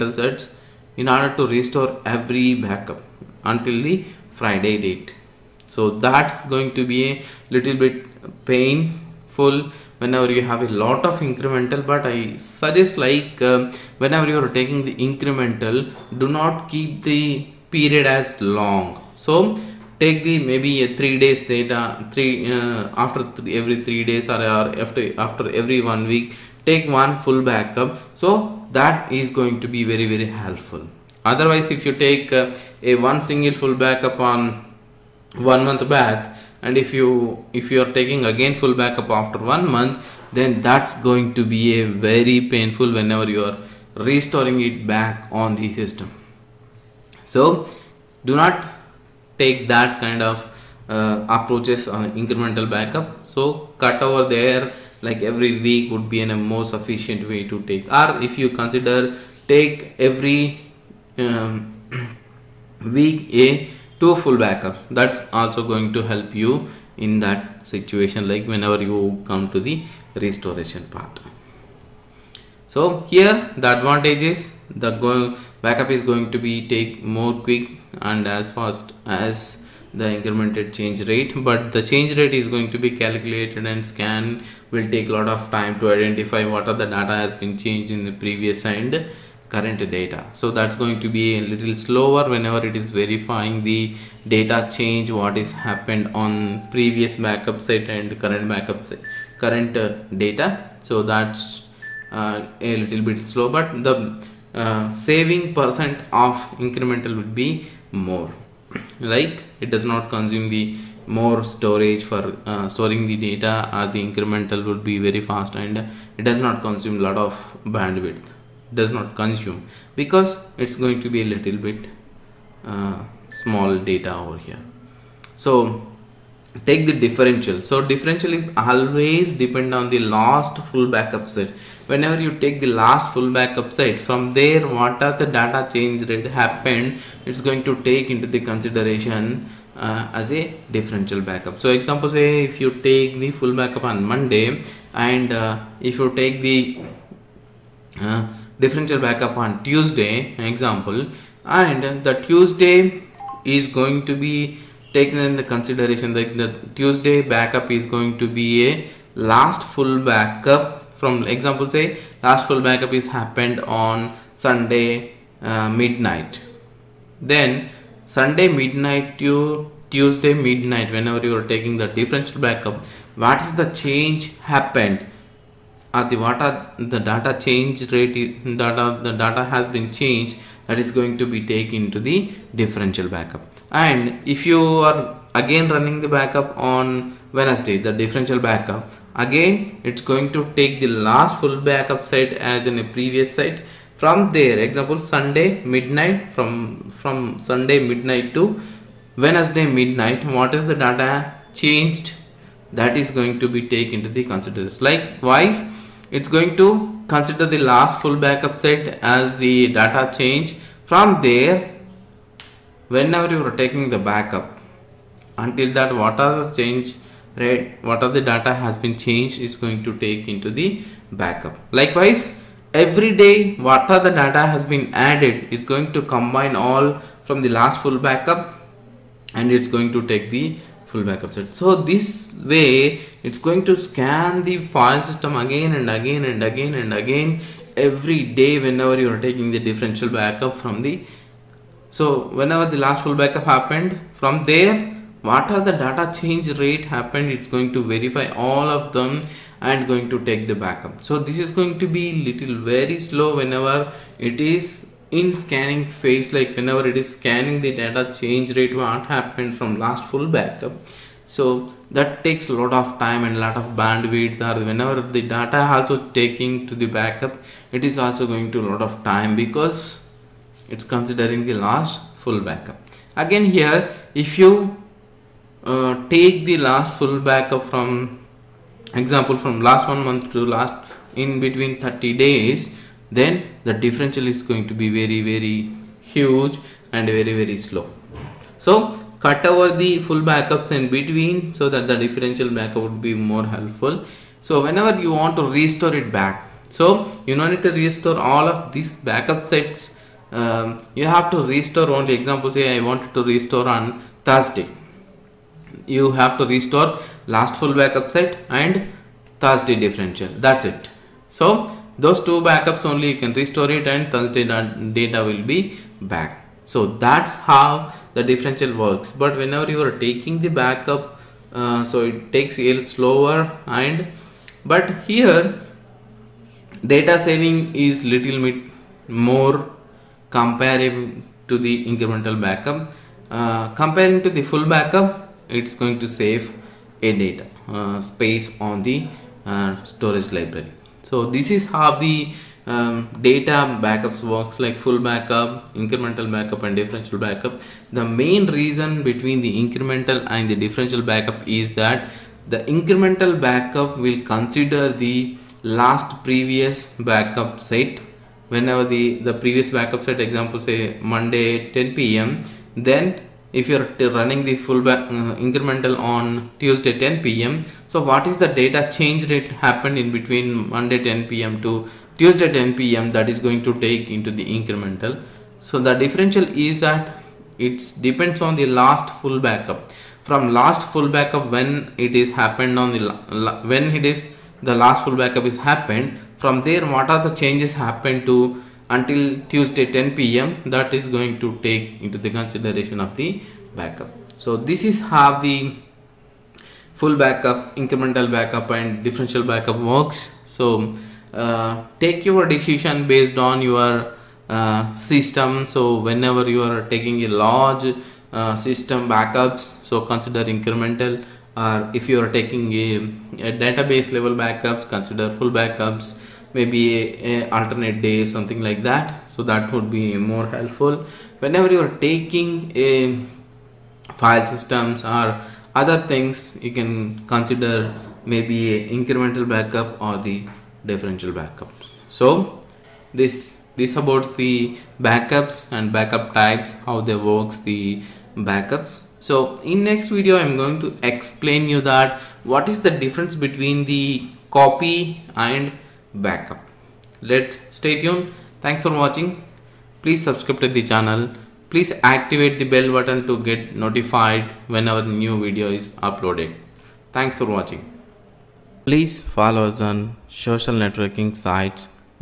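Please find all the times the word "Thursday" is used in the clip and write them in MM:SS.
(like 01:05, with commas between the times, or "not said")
05:04, 05:09, 05:14.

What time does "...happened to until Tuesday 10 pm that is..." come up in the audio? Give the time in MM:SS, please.
06:27.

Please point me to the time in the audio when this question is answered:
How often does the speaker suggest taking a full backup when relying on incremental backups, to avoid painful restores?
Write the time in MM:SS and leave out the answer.
00:55.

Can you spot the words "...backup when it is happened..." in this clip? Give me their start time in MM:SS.
06:21.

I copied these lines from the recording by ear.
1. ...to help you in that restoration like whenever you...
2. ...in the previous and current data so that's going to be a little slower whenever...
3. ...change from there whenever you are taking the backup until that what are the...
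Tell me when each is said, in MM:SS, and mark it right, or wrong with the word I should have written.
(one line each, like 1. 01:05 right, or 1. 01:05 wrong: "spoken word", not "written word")
1. 01:05 wrong: "situation", not "restoration"
2. 01:27 right
3. 03:30 right.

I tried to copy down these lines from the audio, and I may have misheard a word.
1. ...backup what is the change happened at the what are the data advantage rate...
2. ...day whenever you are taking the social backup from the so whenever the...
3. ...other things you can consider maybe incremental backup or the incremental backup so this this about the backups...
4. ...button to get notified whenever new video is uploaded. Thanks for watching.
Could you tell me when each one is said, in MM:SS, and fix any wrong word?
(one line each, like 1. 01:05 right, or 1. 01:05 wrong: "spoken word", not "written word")
1. 02:52 wrong: "change", not "advantage"
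2. 03:58 wrong: "differential", not "social"
3. 07:05 wrong: "differential", not "incremental"
4. 07:32 right.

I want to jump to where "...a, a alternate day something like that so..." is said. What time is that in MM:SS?
06:57.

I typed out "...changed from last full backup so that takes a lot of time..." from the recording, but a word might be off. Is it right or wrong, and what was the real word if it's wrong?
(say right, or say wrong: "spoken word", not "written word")
wrong: "happened", not "changed".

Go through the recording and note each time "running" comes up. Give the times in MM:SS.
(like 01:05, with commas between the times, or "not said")
03:05, 06:04.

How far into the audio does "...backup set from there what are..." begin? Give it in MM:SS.
02:13.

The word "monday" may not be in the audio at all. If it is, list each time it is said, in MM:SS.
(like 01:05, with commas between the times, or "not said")
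02:24, 06:01, 06:10.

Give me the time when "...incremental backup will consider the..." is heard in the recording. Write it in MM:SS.
05:52.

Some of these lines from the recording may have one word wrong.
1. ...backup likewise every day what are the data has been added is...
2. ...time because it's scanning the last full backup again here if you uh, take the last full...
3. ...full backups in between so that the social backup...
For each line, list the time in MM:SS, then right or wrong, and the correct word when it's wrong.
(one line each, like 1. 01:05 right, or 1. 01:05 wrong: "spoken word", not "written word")
1. 03:41 right
2. 04:29 wrong: "considering", not "scanning"
3. 04:49 wrong: "differential", not "social".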